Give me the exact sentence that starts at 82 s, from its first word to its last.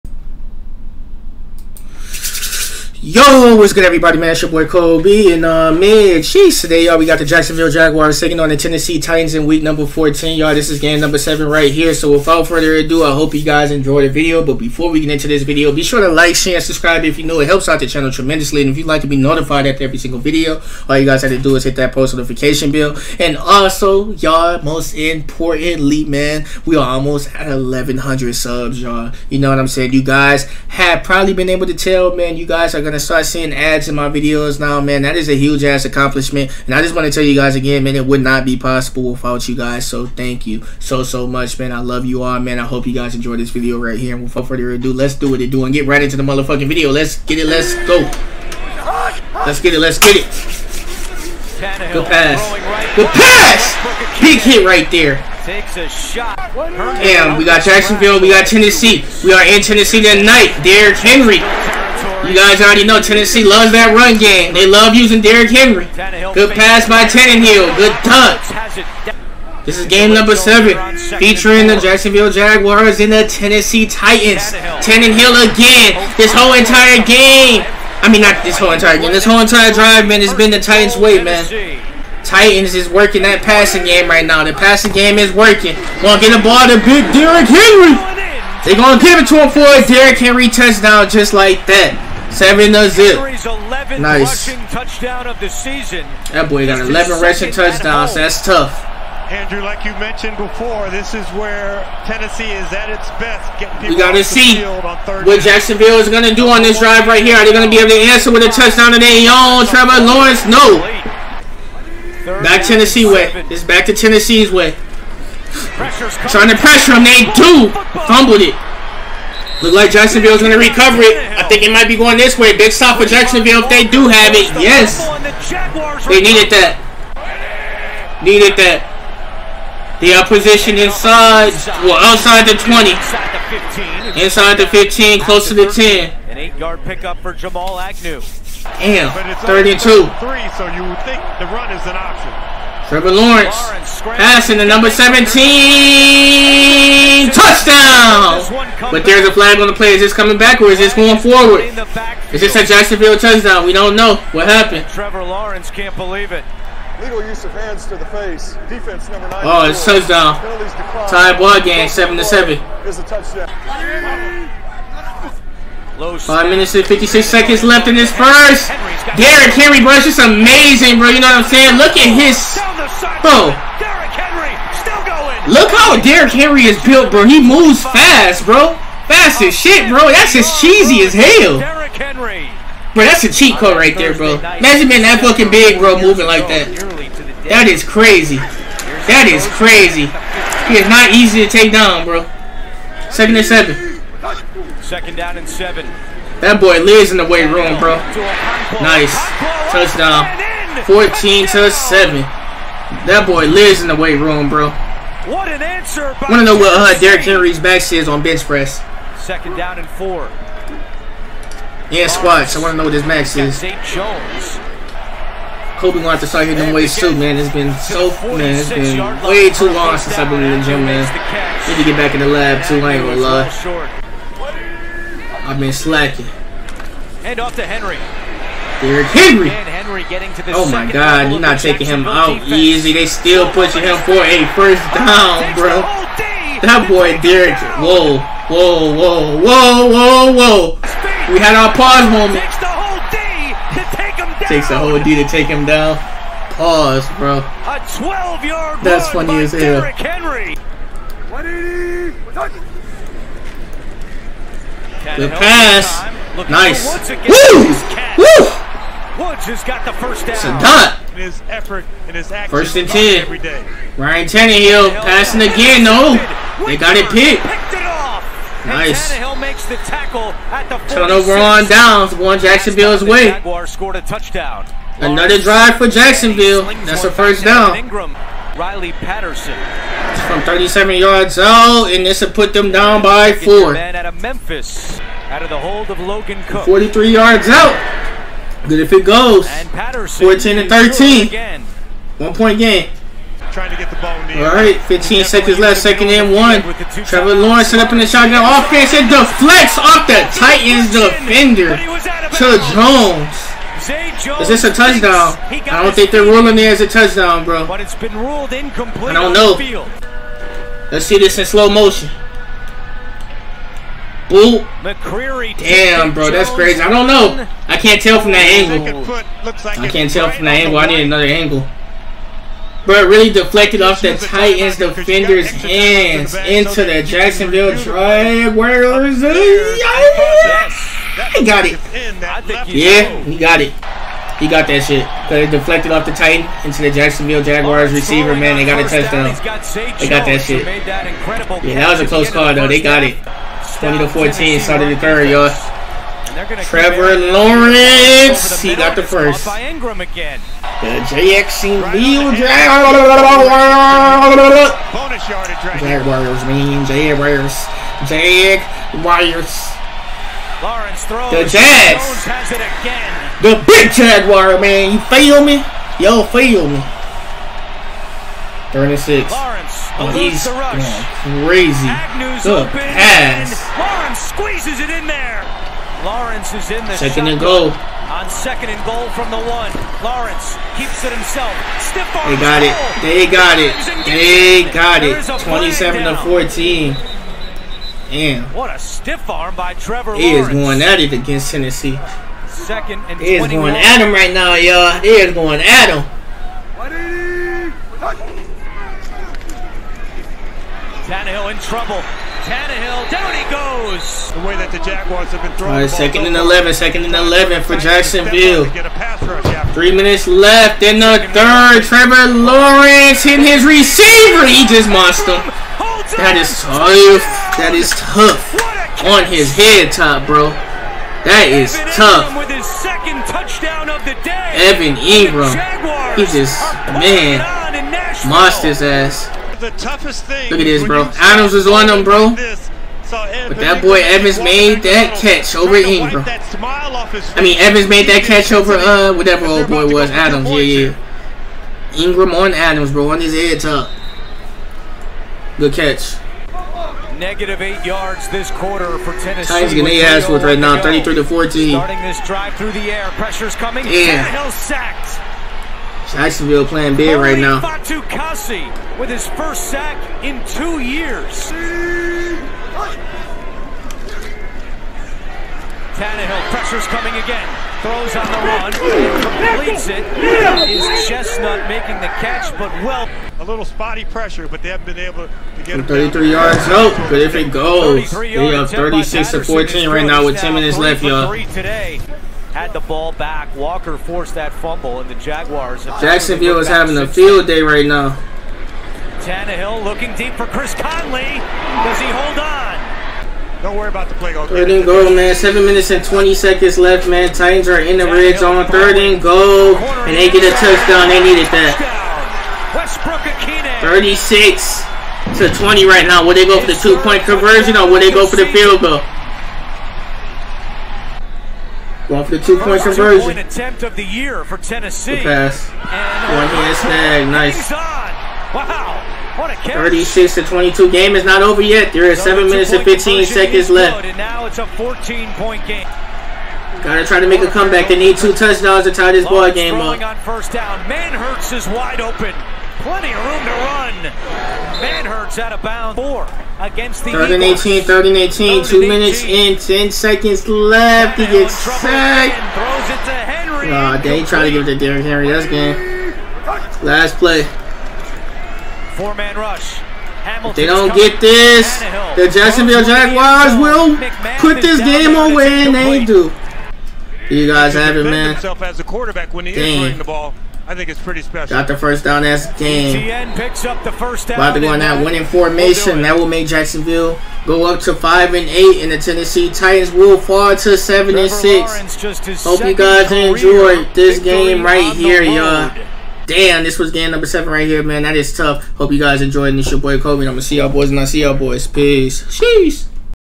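Titans is working that passing game right now.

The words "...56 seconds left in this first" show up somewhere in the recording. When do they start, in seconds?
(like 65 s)
166 s.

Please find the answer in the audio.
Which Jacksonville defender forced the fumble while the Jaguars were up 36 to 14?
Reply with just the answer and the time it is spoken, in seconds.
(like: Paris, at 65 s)
Walker, at 483 s.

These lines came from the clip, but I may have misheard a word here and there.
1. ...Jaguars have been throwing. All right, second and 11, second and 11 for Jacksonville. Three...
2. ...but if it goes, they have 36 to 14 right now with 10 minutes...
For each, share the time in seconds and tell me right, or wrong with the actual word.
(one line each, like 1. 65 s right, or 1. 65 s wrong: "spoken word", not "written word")
1. 404 s right
2. 477 s right.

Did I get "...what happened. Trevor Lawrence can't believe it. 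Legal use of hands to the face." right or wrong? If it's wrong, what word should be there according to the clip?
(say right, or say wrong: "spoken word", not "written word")
right.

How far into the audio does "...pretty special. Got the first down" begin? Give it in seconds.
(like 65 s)
561 s.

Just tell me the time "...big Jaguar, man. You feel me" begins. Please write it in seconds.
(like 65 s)
363 s.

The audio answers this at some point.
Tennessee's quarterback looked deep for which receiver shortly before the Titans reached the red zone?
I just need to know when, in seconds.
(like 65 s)
490 s.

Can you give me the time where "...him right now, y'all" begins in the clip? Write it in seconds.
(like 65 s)
393 s.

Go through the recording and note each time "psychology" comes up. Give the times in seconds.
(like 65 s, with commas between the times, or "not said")
not said.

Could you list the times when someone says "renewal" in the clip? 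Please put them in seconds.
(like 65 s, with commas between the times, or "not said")
not said.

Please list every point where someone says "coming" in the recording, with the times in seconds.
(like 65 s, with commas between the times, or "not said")
150 s, 453 s, 466 s.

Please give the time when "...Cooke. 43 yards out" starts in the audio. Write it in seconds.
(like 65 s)
286 s.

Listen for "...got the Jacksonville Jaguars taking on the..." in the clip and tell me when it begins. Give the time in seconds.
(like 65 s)
7 s.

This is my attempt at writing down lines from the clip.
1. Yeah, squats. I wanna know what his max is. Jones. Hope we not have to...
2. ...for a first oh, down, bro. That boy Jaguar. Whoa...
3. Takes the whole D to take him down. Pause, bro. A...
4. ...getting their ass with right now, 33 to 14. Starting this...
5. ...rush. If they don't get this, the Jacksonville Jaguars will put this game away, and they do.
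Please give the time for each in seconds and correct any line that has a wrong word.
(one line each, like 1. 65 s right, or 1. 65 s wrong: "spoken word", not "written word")
1. 211 s right
2. 234 s wrong: "Derrick", not "Jaguar"
3. 244 s right
4. 449 s right
5. 549 s right.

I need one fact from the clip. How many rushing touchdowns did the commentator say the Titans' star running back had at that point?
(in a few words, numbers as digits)
11.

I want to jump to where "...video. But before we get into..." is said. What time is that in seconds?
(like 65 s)
14 s.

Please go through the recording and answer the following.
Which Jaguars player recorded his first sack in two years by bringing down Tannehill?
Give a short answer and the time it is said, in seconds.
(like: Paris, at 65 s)
Fatukasi, at 457 s.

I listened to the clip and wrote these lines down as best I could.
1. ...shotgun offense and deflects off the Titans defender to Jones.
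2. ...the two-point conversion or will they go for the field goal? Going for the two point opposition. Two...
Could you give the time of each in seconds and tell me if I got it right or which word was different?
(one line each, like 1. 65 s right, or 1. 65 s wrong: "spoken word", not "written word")
1. 298 s right
2. 506 s wrong: "conversion", not "opposition".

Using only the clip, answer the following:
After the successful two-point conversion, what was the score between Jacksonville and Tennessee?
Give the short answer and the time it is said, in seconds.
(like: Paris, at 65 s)
36 to 22, at 519 s.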